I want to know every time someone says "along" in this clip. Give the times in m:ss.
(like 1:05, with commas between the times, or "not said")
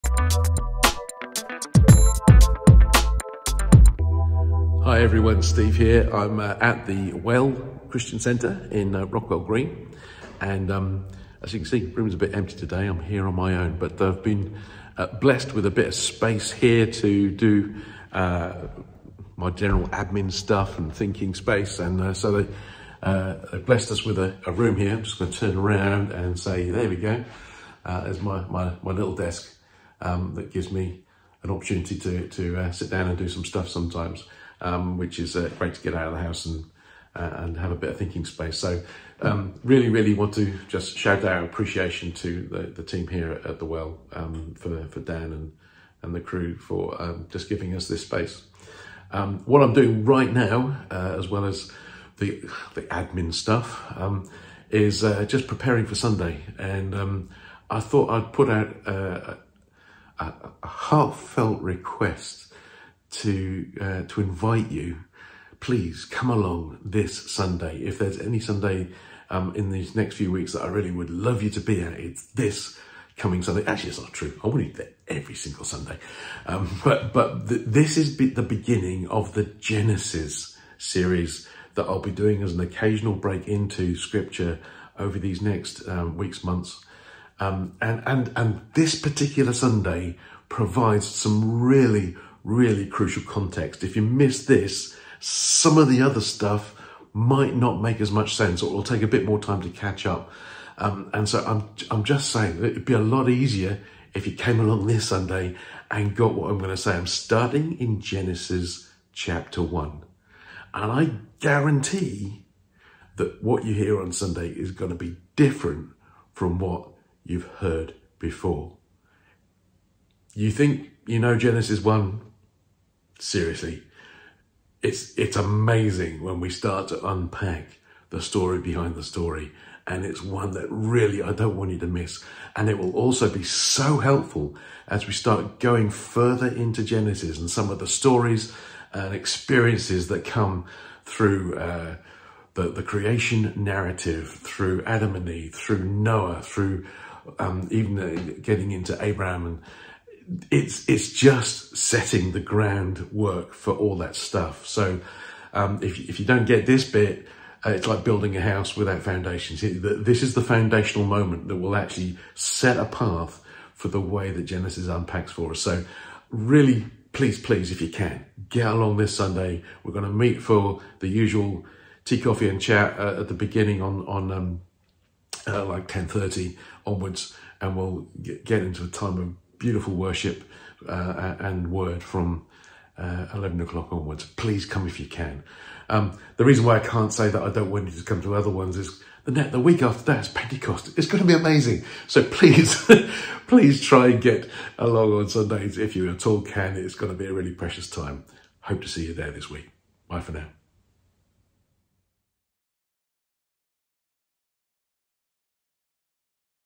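1:06, 1:44, 2:48, 3:14.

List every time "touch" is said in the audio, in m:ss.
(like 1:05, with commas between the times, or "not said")
not said.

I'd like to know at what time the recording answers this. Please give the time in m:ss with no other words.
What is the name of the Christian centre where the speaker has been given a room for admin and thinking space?
0:07.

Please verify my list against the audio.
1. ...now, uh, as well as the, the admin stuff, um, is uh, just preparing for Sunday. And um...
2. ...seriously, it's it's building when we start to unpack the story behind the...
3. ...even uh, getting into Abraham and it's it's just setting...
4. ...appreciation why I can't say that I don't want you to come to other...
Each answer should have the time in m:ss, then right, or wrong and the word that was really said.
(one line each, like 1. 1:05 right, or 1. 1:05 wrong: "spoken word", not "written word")
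1. 0:50 right
2. 2:03 wrong: "amazing", not "building"
3. 2:27 right
4. 3:06 wrong: "reason", not "appreciation".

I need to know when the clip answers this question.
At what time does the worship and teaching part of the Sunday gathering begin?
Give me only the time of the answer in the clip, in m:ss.
3:03.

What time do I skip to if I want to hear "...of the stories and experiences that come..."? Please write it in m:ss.
2:17.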